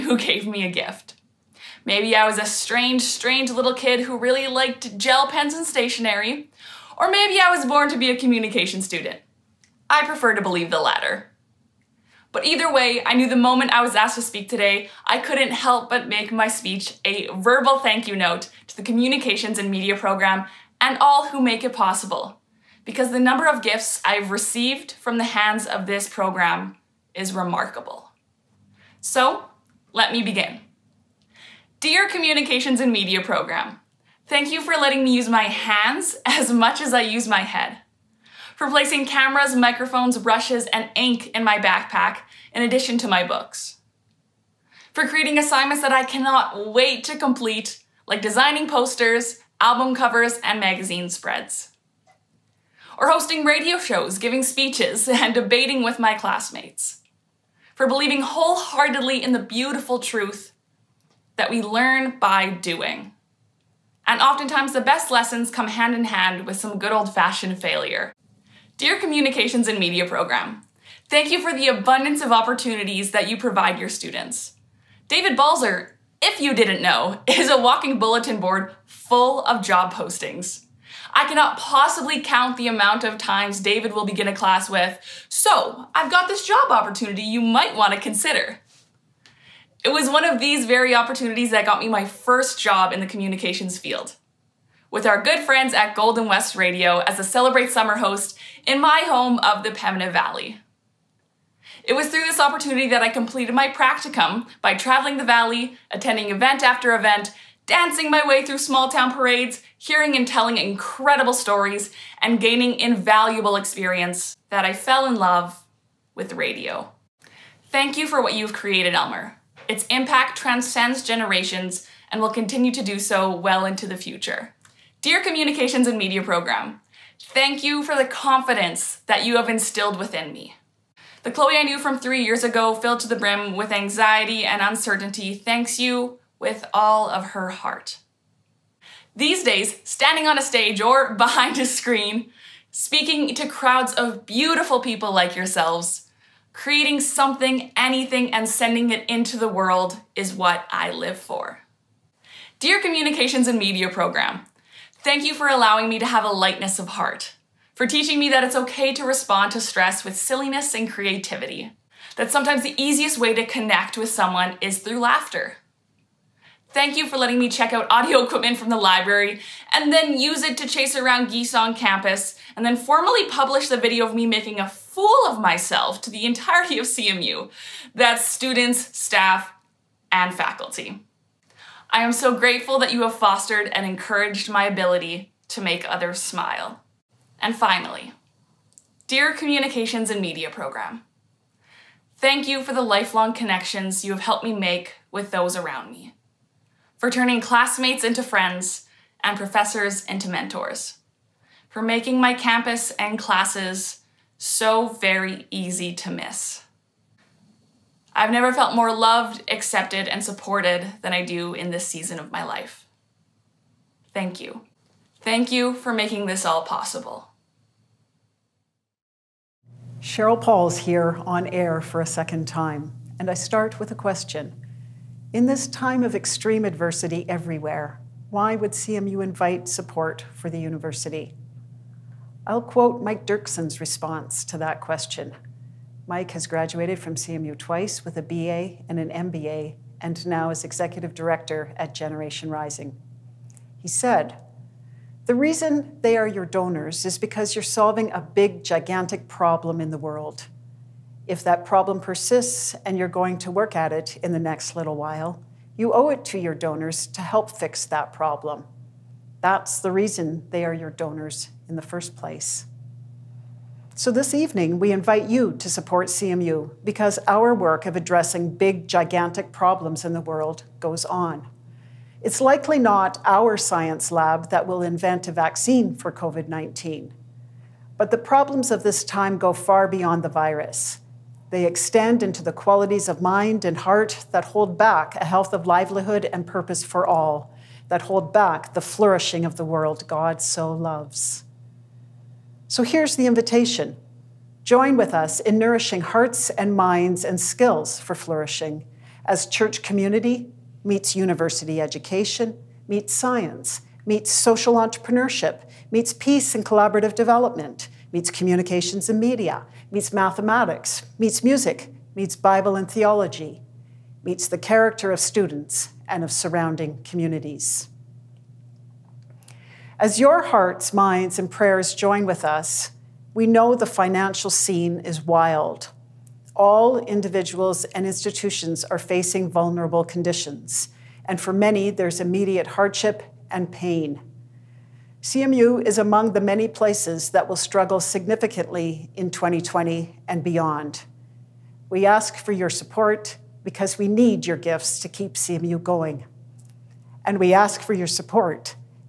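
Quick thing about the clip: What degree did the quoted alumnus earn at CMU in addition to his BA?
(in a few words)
MBA.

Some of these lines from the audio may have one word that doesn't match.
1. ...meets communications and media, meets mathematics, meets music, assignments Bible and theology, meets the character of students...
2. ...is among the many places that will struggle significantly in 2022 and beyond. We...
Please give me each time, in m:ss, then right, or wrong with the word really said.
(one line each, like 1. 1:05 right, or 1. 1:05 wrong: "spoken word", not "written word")
1. 5:08 wrong: "meets", not "assignments"
2. 5:35 wrong: "2020", not "2022".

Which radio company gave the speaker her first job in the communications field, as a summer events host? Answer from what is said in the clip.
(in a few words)
Golden West Radio.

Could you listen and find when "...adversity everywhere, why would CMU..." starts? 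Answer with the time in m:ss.
3:46.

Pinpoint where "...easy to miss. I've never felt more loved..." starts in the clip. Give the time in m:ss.
3:25.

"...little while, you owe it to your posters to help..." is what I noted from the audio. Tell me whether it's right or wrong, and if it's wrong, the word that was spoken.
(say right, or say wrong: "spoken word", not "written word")
wrong: "donors", not "posters".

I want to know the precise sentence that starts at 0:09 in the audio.
I prefer to believe the latter.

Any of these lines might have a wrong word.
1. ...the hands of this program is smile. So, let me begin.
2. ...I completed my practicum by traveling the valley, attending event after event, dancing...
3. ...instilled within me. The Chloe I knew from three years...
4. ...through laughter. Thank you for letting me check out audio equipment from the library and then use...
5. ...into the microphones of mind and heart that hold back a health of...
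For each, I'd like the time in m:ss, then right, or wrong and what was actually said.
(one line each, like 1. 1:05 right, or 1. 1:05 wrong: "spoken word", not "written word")
1. 0:25 wrong: "remarkable", not "smile"
2. 1:43 right
3. 2:09 right
4. 2:44 right
5. 4:42 wrong: "qualities", not "microphones".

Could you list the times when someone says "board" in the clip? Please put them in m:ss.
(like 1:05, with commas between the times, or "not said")
1:18.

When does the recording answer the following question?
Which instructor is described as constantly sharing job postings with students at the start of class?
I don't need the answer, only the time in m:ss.
1:15.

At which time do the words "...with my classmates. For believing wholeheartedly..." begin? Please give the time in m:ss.
0:55.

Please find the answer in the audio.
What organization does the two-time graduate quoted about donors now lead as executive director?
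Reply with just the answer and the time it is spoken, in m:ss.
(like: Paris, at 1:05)
Generation Rising, at 4:01.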